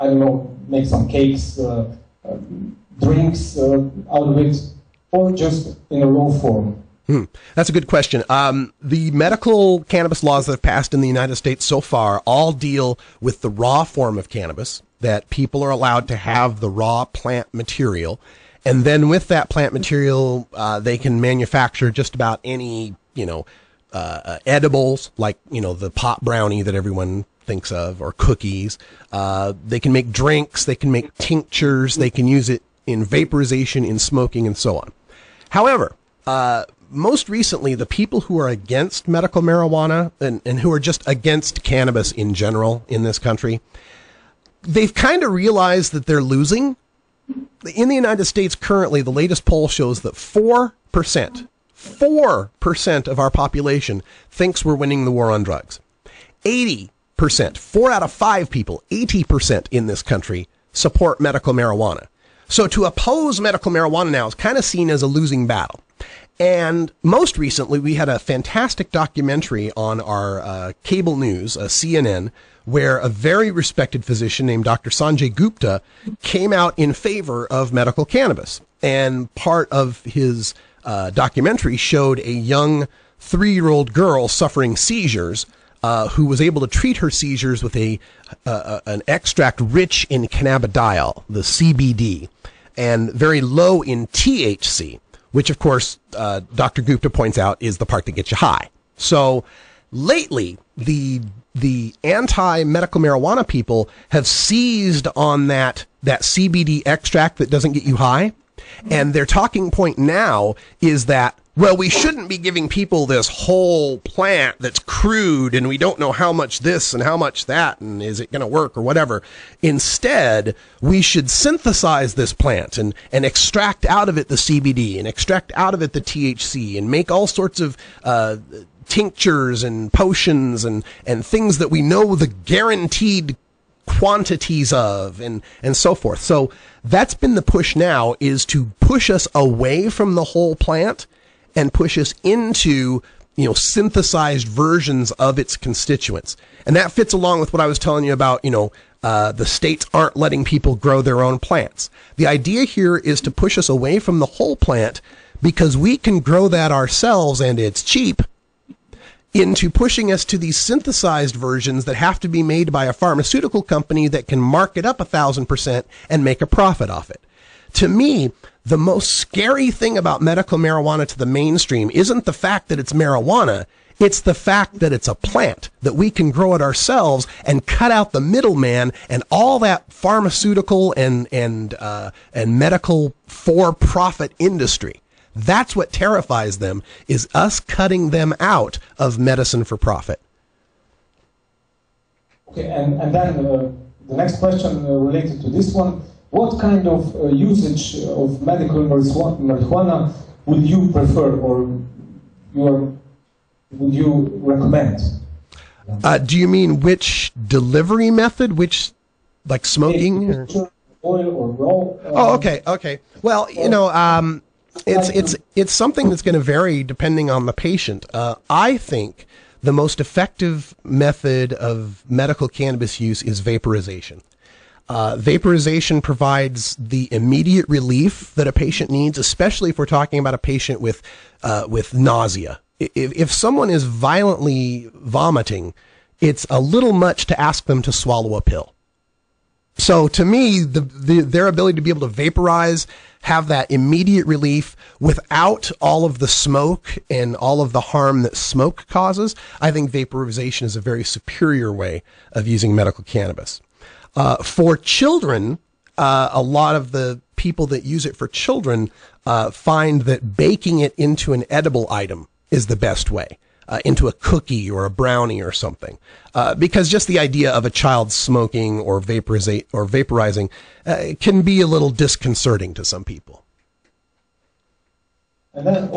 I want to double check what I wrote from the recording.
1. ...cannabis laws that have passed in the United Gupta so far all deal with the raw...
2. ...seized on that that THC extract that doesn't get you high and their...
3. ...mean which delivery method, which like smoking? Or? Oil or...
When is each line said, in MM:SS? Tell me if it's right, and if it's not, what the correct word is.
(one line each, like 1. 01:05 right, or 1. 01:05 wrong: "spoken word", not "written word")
1. 00:09 wrong: "States", not "Gupta"
2. 01:44 wrong: "CBD", not "THC"
3. 03:26 right.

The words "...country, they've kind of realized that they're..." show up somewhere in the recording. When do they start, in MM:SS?
00:43.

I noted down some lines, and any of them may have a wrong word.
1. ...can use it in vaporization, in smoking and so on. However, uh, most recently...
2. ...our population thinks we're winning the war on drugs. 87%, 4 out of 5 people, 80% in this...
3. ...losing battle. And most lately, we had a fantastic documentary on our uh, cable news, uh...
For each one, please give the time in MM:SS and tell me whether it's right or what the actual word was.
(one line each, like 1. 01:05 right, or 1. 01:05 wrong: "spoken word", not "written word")
1. 00:32 right
2. 00:53 wrong: "80", not "87"
3. 01:05 wrong: "recently", not "lately".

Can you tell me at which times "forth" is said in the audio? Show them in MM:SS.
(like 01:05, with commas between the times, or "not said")
02:15.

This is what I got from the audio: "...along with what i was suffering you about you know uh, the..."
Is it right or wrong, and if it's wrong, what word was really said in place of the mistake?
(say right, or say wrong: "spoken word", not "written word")
wrong: "telling", not "suffering".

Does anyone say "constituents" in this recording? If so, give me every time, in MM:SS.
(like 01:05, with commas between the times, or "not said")
02:25.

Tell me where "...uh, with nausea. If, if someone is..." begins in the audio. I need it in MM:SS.
03:51.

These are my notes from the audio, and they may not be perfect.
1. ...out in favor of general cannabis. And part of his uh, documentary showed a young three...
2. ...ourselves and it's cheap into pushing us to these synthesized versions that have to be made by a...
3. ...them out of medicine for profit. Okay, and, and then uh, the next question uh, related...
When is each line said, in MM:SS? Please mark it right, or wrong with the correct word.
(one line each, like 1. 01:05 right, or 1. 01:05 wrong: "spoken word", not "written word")
1. 01:16 wrong: "medical", not "general"
2. 02:36 right
3. 03:08 right.